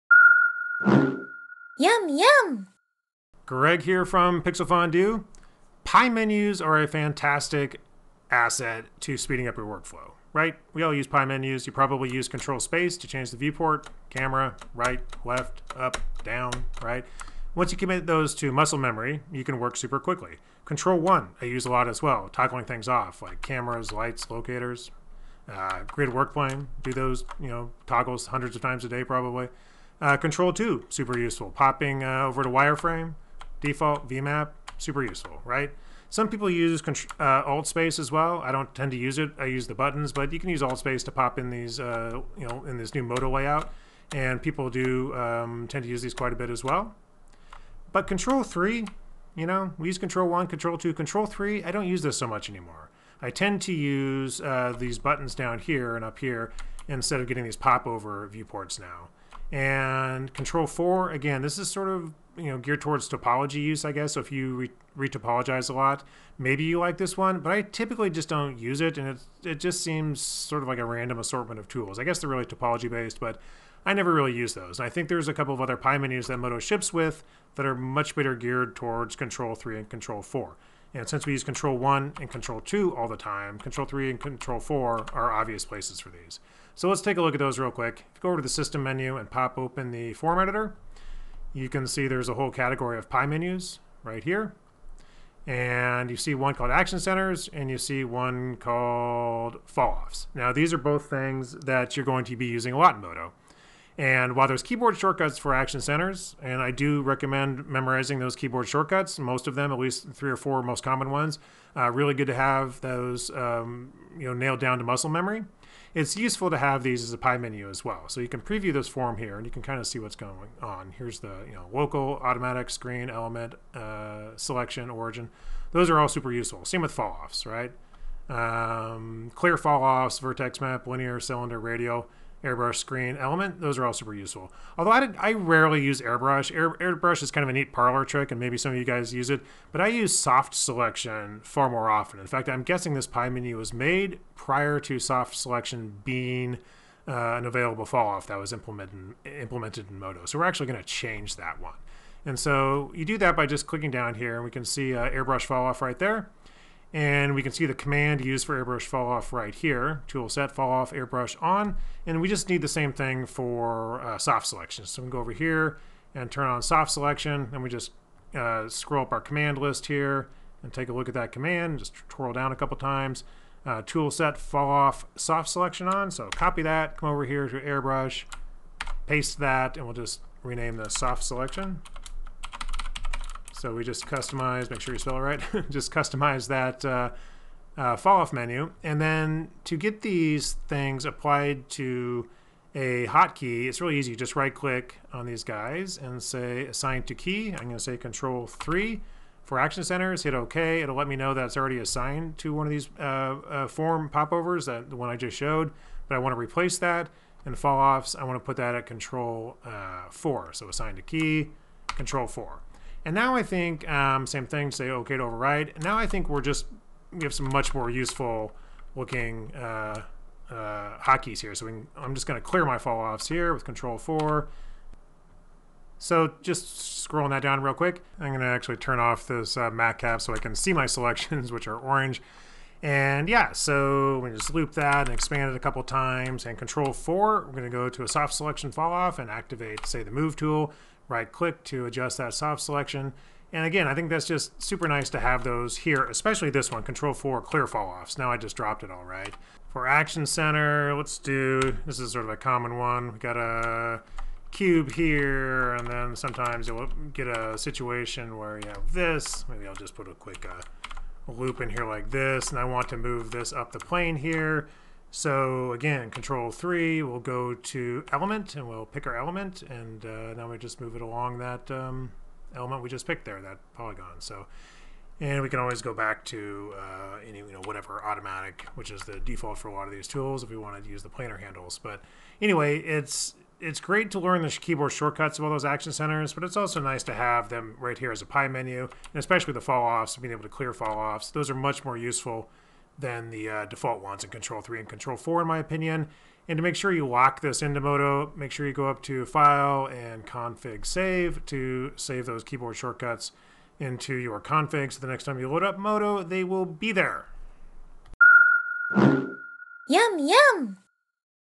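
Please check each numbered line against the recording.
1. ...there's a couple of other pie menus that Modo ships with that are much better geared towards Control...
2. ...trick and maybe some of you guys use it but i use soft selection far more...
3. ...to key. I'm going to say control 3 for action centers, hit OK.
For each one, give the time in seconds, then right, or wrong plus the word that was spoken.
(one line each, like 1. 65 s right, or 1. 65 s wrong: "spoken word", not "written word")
1. 75 s right
2. 138 s right
3. 197 s right.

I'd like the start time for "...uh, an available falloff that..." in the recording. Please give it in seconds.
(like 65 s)
147 s.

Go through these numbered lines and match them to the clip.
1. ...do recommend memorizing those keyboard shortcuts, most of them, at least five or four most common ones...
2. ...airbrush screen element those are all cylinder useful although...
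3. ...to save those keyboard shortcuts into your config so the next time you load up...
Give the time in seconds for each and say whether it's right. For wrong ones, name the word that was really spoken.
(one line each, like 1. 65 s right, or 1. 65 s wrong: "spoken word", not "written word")
1. 106 s wrong: "three", not "five"
2. 132 s wrong: "super", not "cylinder"
3. 301 s right.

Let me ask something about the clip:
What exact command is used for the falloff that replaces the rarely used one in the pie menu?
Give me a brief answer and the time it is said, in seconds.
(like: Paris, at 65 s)
tool set fall off soft selection on, at 173 s.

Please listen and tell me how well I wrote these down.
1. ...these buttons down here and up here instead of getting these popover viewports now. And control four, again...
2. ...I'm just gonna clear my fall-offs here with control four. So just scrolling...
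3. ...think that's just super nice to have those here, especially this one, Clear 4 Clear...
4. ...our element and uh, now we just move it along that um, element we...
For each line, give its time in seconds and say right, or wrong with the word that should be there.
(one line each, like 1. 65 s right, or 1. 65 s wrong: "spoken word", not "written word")
1. 54 s right
2. 221 s right
3. 243 s wrong: "Control", not "Clear"
4. 269 s right.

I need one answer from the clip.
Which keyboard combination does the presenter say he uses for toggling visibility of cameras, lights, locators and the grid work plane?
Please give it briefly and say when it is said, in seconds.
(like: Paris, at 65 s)
Control 1, at 20 s.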